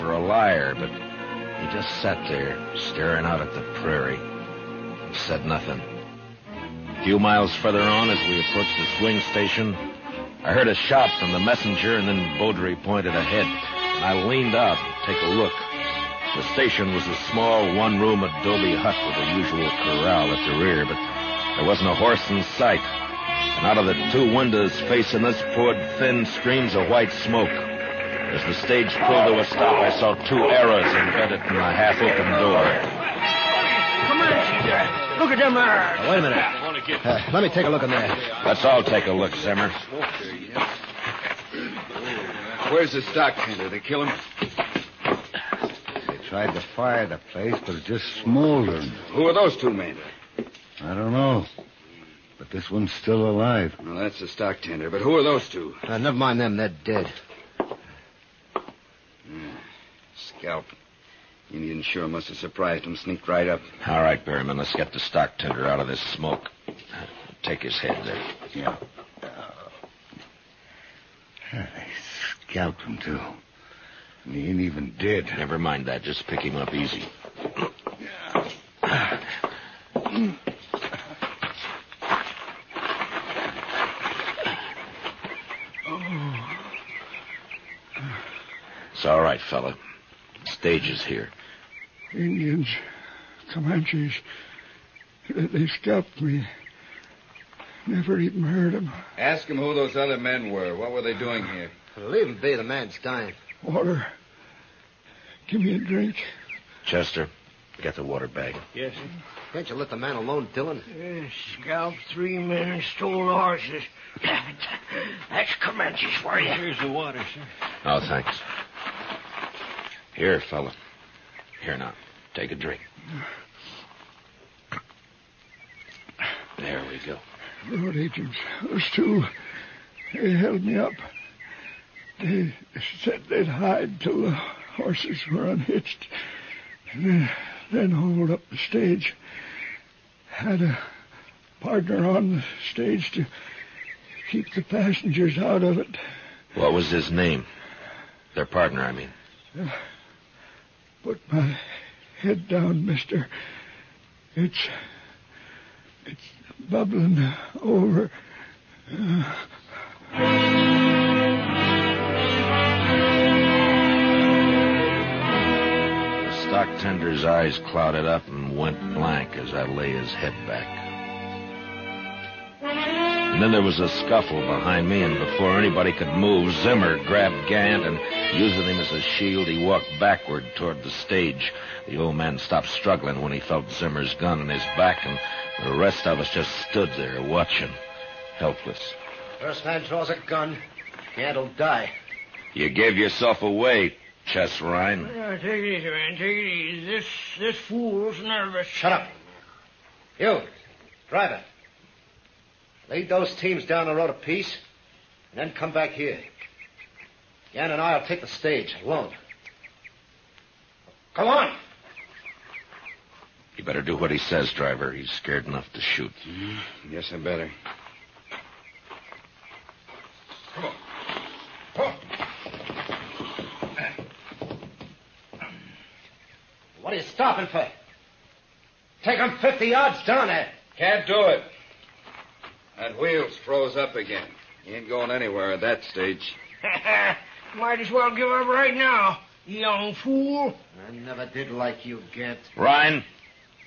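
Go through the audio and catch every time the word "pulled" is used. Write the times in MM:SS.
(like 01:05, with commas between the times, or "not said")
00:28.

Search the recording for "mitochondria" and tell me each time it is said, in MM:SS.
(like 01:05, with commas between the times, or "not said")
not said.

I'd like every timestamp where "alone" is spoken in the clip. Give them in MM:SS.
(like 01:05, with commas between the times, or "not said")
01:50, 03:28.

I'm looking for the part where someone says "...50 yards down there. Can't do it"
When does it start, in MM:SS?
03:49.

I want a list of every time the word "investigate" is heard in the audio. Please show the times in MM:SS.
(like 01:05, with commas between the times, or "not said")
not said.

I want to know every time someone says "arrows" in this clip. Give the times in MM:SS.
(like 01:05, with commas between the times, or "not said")
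00:30, 00:35.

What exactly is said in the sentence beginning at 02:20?
Had a partner on the stage to keep the passengers out of it.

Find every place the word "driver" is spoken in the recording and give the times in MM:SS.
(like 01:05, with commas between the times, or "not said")
03:21, 03:34.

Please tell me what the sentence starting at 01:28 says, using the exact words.
It's all right, fella stages here?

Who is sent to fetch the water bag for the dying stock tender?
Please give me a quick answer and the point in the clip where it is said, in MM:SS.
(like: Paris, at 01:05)
Chester, at 01:46.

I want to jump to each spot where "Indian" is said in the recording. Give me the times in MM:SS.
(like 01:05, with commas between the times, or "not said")
01:01, 01:32.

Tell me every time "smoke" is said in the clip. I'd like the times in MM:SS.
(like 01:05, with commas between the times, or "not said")
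00:27, 01:06.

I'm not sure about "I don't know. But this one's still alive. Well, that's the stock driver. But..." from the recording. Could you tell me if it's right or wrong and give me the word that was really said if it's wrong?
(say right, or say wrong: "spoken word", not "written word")
wrong: "tender", not "driver".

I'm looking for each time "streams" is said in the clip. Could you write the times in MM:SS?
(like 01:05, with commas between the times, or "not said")
00:26.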